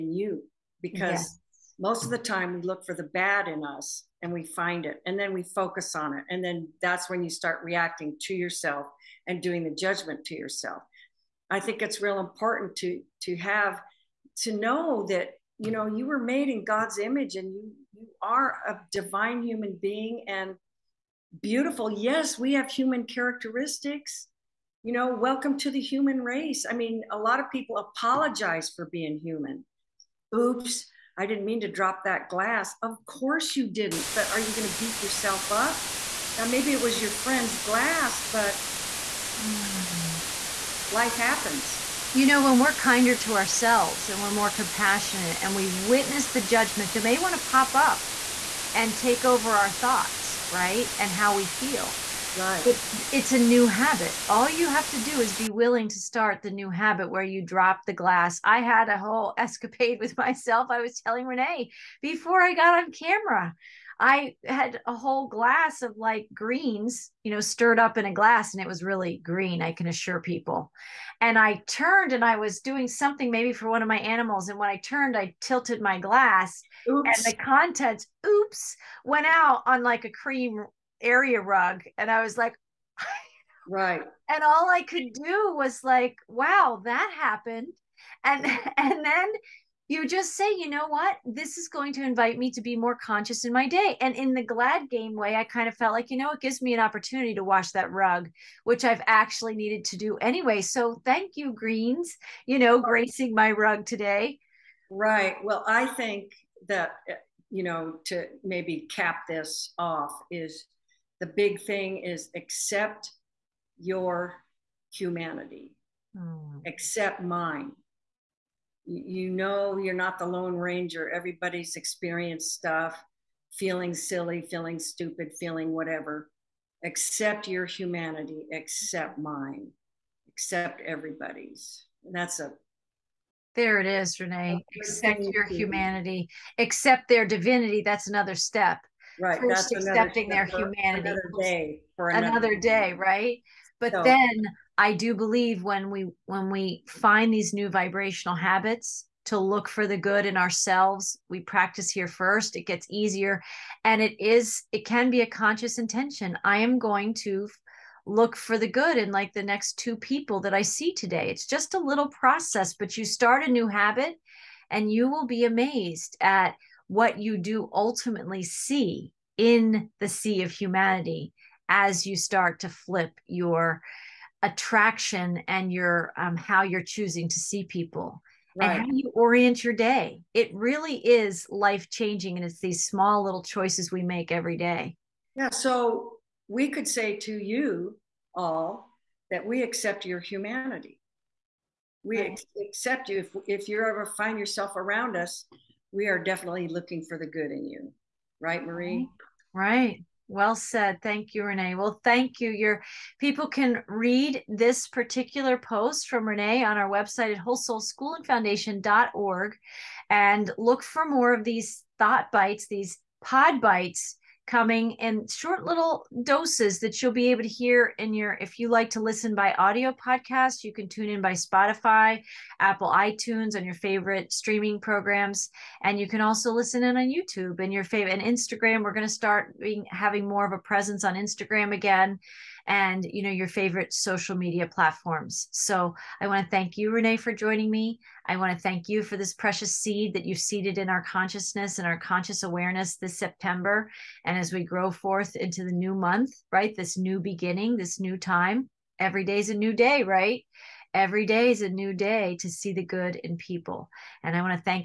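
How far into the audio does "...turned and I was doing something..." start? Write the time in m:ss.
1:11.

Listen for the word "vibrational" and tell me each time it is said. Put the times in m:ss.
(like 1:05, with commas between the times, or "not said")
2:27.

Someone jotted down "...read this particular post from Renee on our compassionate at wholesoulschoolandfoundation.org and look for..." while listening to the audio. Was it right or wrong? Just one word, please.
wrong.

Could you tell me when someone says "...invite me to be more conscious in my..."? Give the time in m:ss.
1:32.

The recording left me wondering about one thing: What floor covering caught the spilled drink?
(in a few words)
cream area rug.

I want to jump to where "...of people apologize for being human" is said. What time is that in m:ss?
0:27.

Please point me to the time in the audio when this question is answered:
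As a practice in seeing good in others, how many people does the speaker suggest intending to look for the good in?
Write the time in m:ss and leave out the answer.
2:39.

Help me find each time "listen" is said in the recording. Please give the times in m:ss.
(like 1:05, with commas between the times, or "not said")
3:38, 3:46.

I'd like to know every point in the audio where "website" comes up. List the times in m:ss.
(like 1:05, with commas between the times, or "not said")
3:26.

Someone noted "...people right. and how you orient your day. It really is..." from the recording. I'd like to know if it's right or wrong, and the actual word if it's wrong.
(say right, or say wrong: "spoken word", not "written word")
right.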